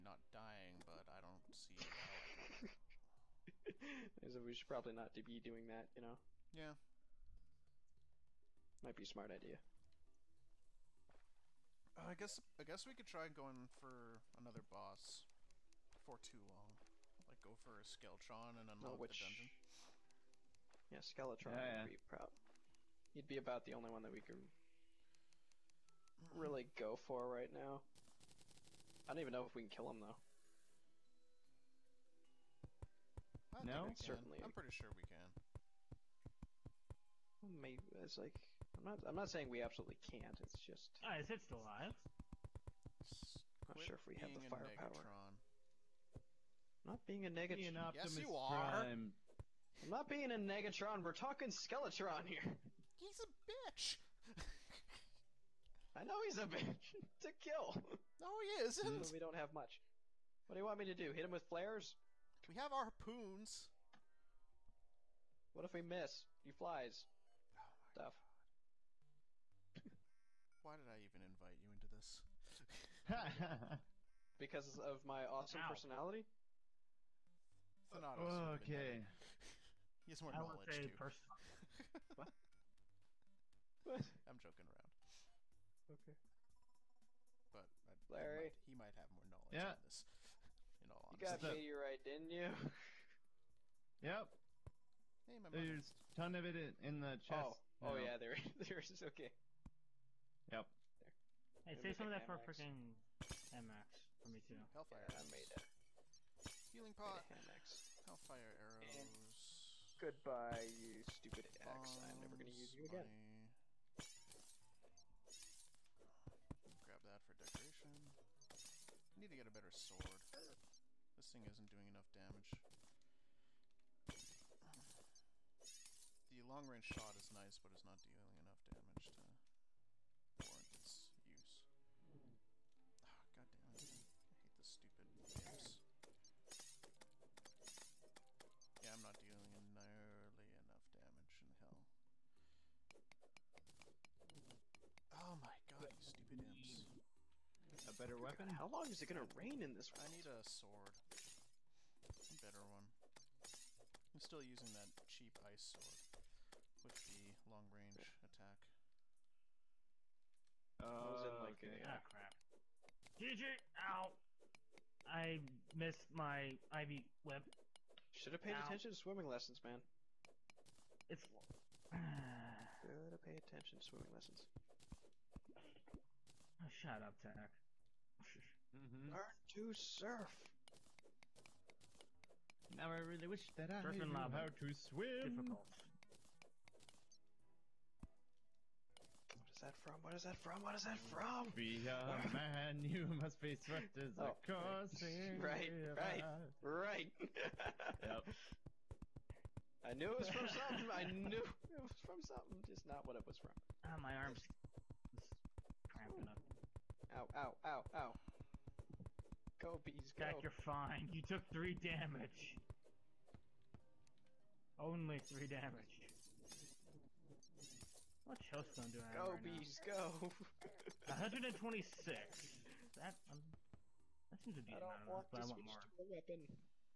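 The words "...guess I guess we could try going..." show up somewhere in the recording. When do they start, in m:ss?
0:12.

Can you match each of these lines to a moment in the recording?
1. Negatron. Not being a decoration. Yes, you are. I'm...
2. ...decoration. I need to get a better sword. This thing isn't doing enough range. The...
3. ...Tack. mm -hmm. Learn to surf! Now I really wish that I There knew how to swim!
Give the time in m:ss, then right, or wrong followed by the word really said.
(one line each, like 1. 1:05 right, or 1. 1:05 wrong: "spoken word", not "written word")
1. 0:44 wrong: "negatron", not "decoration"
2. 1:57 wrong: "damage", not "range"
3. 2:57 wrong: "Surfing", not "There".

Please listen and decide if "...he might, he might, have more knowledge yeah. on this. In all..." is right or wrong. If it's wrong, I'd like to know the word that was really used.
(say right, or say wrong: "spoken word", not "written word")
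right.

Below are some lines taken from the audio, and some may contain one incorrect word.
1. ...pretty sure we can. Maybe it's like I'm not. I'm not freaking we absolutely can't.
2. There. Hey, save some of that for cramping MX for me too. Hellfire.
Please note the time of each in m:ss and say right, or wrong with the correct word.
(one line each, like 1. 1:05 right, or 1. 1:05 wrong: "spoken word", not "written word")
1. 0:34 wrong: "saying", not "freaking"
2. 1:40 wrong: "freaking", not "cramping".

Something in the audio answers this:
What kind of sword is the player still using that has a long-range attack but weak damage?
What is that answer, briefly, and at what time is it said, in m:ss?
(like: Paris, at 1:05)
ice sword, at 2:35.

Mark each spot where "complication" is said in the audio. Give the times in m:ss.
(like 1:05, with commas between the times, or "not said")
not said.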